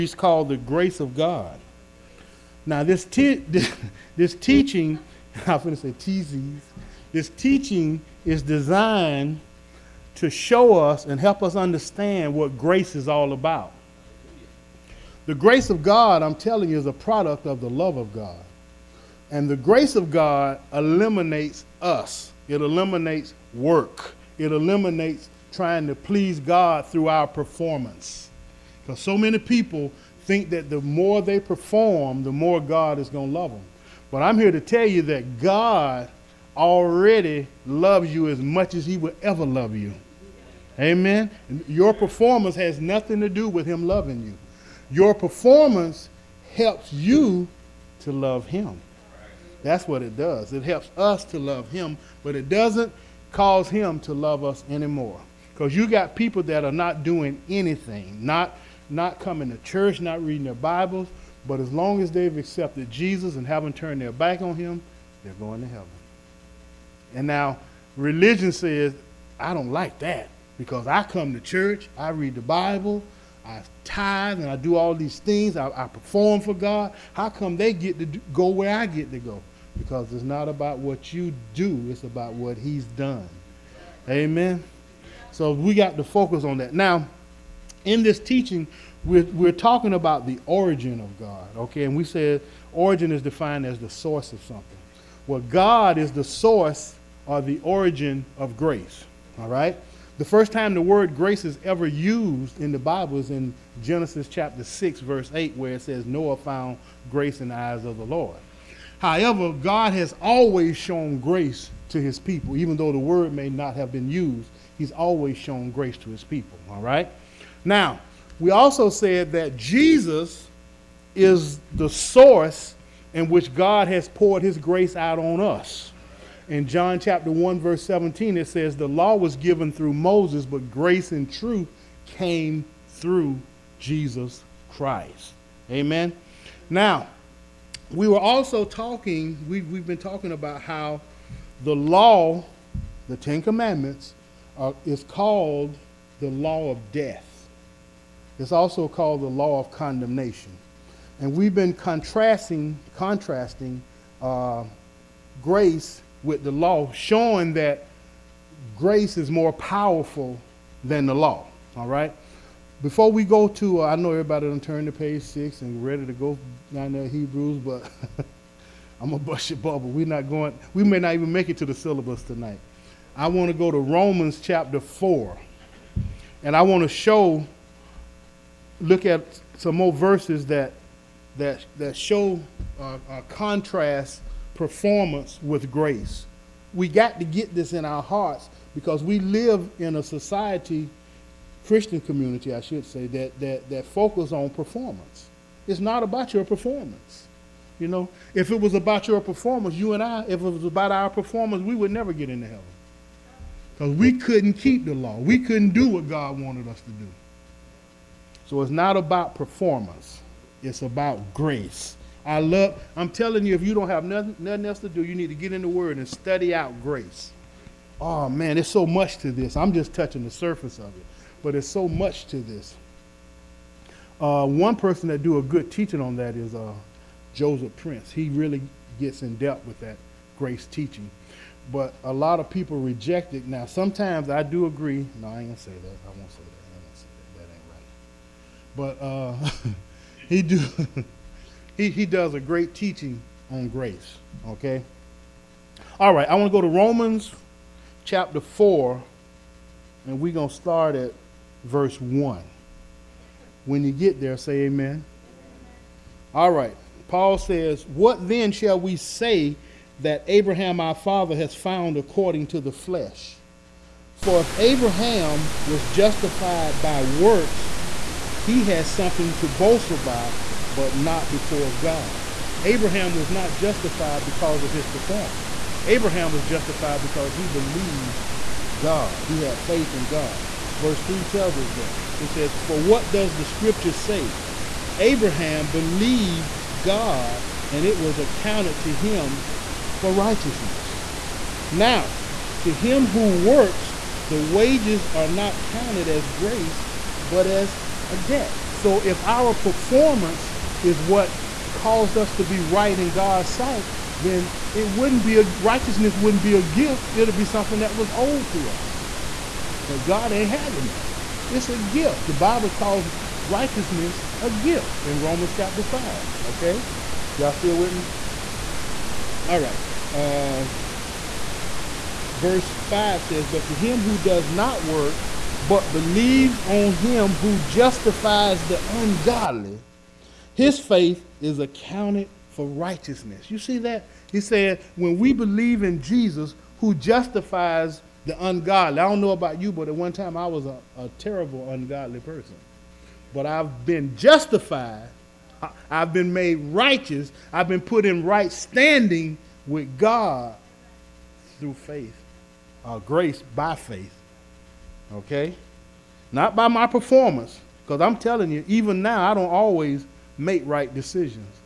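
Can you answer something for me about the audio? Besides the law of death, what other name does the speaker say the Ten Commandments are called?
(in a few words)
law of condemnation.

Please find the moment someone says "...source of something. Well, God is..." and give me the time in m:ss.
1:33.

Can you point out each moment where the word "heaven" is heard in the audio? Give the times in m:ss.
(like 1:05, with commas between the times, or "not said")
1:05, 3:22.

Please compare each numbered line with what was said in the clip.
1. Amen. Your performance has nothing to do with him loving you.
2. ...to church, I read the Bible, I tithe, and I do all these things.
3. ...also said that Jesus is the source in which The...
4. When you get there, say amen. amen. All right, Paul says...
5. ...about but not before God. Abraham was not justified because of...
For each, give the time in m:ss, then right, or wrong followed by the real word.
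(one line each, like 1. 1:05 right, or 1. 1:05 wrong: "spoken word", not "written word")
1. 0:40 right
2. 1:11 right
3. 1:58 wrong: "God", not "The"
4. 4:13 right
5. 4:29 right.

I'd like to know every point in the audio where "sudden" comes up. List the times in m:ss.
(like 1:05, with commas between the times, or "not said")
not said.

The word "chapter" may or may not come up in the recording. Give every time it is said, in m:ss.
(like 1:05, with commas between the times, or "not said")
1:44, 2:06, 2:54, 4:08, 5:15.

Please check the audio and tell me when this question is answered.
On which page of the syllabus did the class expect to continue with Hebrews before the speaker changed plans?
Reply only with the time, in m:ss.
2:44.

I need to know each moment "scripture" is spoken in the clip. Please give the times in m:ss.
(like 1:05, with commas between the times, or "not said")
4:43.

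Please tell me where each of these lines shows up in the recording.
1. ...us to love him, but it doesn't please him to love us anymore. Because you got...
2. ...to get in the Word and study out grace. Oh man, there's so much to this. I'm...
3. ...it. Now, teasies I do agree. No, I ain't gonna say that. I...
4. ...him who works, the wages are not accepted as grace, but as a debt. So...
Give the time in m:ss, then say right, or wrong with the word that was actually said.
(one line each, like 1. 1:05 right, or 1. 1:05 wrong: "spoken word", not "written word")
1. 0:50 wrong: "cause", not "please"
2. 3:35 right
3. 3:53 wrong: "sometimes", not "teasies"
4. 4:52 wrong: "counted", not "accepted".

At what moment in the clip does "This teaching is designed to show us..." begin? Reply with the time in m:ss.
0:07.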